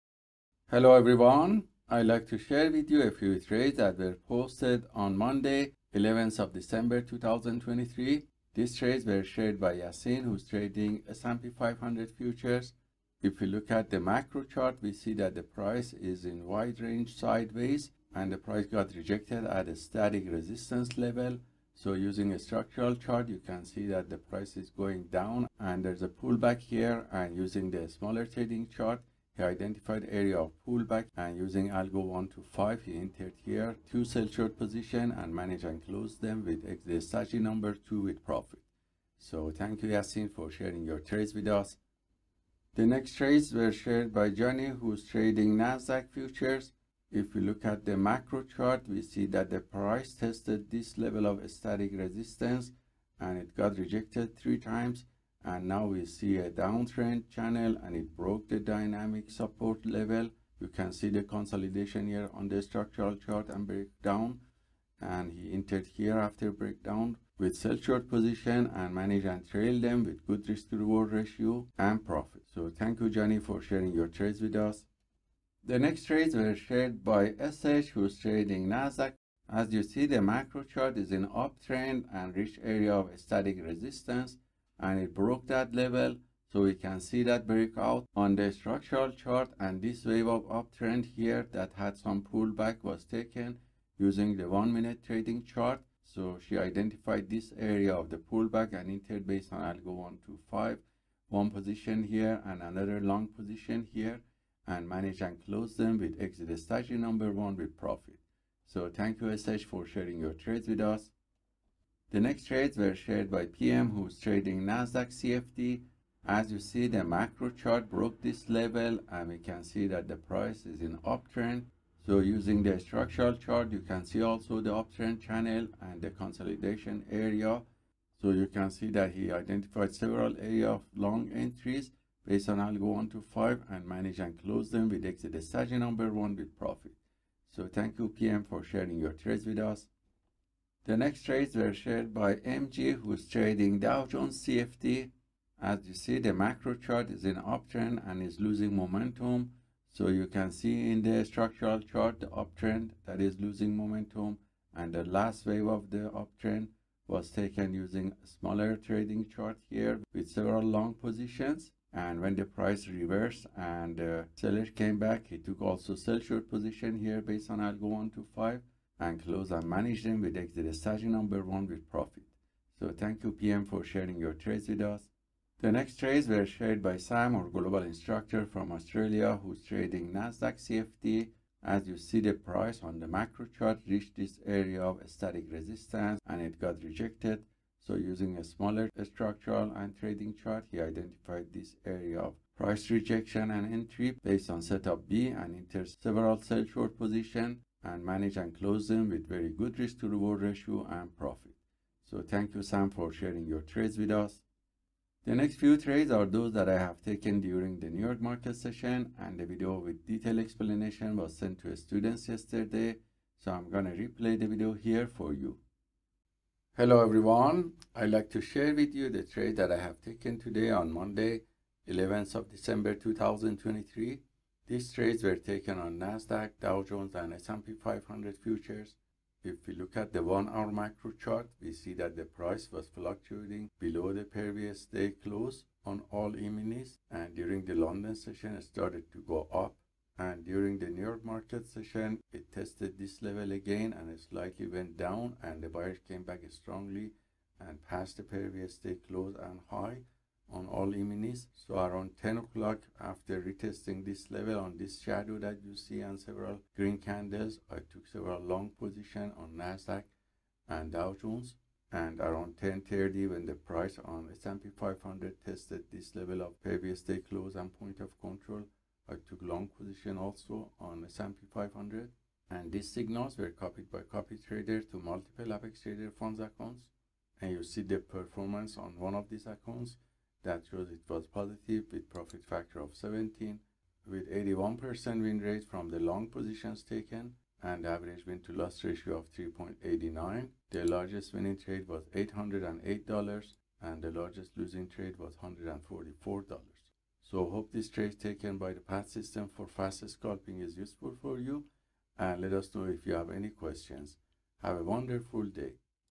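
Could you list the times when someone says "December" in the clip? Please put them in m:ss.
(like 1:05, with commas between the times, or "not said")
0:06, 3:42.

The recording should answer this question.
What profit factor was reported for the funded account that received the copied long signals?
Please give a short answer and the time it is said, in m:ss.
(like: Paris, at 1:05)
17, at 4:42.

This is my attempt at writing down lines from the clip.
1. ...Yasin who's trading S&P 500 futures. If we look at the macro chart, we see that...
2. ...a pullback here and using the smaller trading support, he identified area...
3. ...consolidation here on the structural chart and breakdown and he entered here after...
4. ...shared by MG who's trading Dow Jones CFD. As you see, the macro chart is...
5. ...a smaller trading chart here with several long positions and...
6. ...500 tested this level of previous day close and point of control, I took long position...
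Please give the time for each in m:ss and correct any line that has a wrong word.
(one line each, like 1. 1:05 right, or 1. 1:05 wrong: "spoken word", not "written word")
1. 0:09 right
2. 0:26 wrong: "chart", not "support"
3. 1:01 right
4. 2:21 right
5. 2:38 right
6. 4:24 right.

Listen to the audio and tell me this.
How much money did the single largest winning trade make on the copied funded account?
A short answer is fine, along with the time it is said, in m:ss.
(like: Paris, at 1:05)
$808, at 4:52.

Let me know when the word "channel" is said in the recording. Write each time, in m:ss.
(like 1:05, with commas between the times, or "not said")
0:57, 2:05.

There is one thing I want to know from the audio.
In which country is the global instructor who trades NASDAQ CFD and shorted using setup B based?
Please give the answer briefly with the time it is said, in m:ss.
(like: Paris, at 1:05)
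Australia, at 2:58.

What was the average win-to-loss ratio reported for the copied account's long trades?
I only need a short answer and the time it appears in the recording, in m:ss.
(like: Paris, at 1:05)
3.89, at 4:49.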